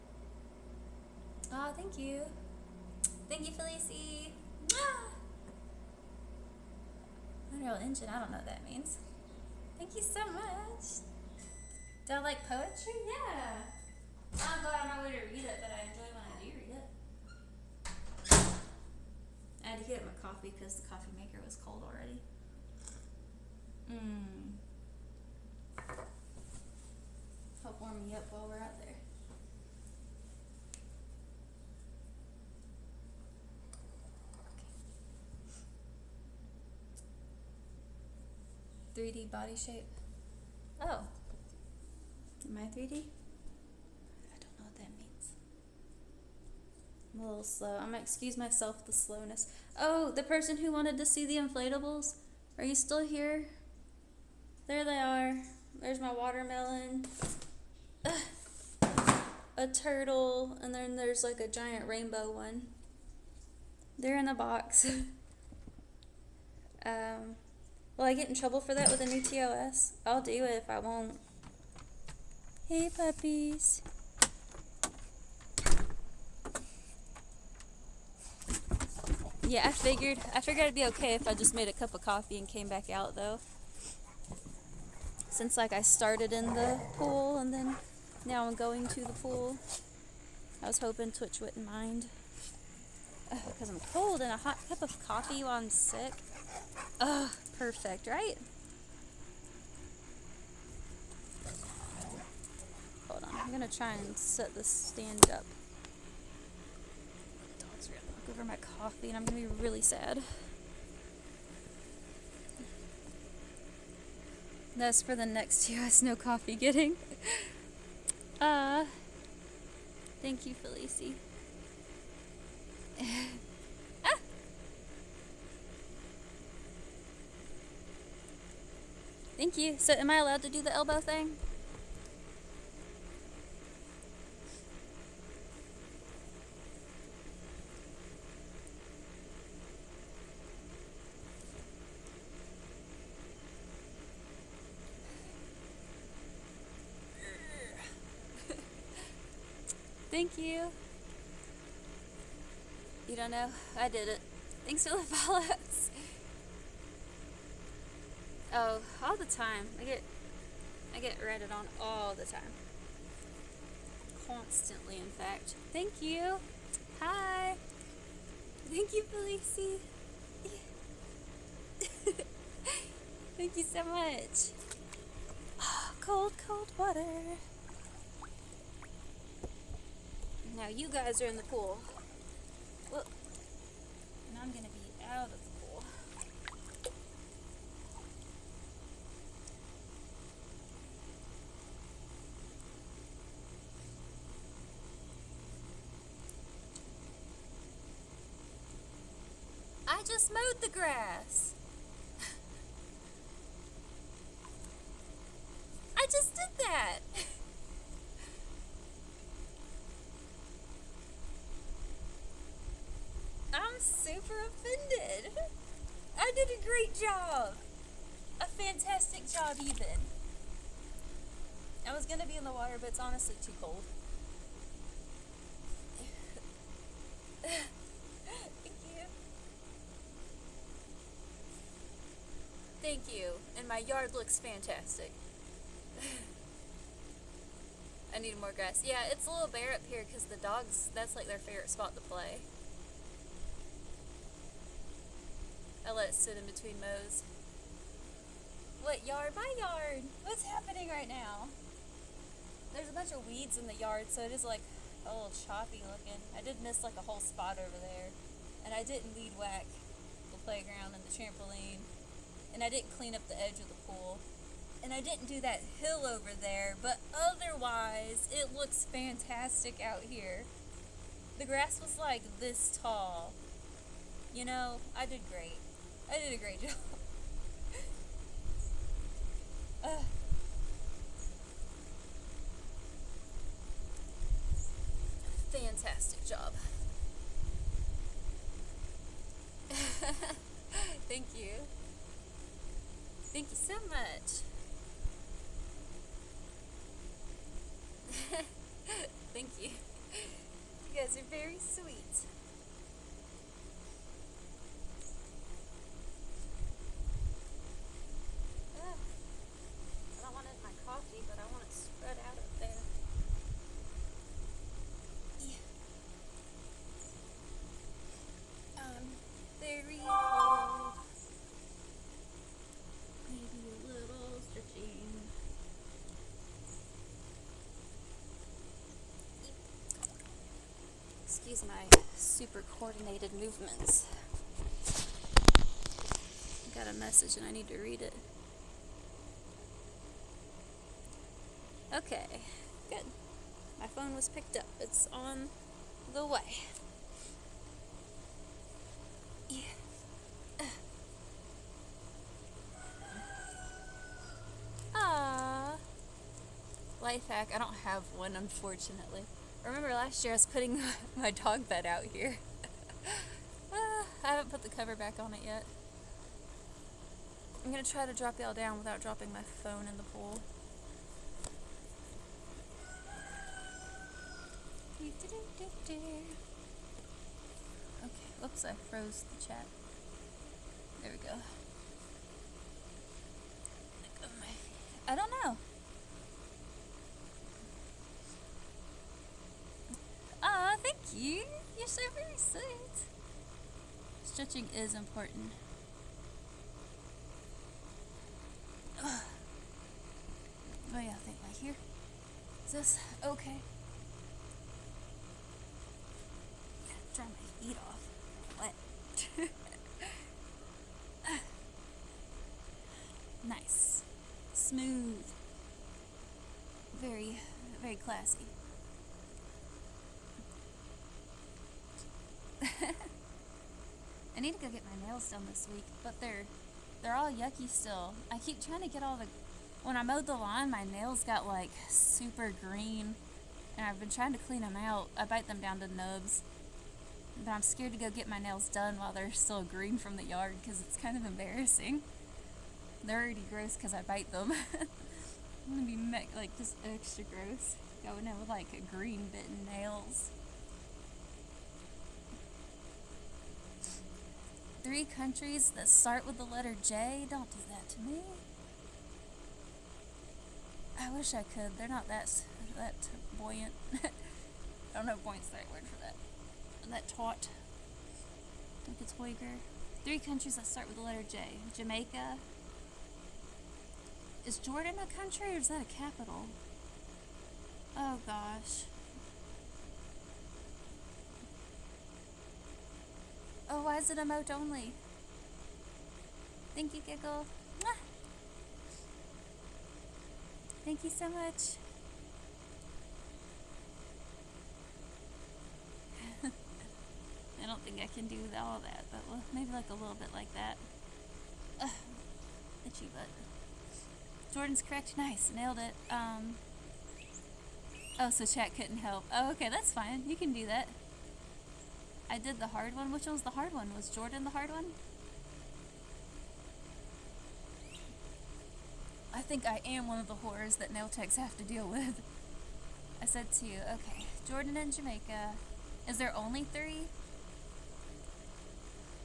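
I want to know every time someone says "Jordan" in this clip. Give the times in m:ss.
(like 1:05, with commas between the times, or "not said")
7:54, 8:24, 8:34, 8:44.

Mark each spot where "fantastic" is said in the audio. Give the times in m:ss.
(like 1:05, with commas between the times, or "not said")
3:38, 3:54, 4:28, 4:45.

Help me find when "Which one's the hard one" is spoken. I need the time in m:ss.
8:33.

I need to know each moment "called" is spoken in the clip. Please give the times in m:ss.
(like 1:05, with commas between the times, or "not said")
not said.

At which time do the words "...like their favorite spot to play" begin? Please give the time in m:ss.
4:01.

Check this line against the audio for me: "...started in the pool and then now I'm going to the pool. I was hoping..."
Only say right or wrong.
right.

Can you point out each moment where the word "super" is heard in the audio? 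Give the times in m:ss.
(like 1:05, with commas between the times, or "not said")
5:32, 7:11.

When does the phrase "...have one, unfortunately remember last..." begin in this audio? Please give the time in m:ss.
5:57.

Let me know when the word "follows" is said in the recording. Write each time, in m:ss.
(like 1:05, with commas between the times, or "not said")
2:35.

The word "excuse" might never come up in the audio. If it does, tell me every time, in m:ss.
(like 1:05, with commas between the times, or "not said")
0:47, 5:31.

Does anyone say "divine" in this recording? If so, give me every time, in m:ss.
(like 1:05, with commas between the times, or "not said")
not said.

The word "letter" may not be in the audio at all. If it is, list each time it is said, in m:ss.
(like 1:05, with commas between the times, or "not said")
7:36, 7:51.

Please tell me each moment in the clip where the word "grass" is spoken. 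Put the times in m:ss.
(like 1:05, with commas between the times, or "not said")
3:20, 3:58, 4:31.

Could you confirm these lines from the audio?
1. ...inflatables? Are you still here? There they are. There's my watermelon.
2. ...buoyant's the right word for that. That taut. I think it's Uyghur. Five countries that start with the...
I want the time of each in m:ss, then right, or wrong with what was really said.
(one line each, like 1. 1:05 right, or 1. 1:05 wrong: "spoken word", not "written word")
1. 0:51 right
2. 7:45 wrong: "Three", not "Five".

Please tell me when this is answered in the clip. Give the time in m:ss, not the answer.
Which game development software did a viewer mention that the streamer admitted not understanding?
0:07.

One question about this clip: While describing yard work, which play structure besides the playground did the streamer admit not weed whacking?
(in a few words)
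The trampoline.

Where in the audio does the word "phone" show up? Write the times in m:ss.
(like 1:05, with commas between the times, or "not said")
5:43, 6:09.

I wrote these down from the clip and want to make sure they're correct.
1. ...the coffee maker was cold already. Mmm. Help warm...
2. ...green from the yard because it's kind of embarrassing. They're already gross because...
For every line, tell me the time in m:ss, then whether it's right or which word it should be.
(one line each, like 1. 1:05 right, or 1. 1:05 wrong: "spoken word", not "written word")
1. 0:20 right
2. 7:19 right.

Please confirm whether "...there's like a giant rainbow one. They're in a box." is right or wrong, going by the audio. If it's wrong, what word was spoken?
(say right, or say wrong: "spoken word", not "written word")
right.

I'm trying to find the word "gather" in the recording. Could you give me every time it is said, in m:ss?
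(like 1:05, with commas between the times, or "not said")
not said.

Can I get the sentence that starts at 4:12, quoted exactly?
There's a bunch of weeds in the yard, so it is like a little choppy looking.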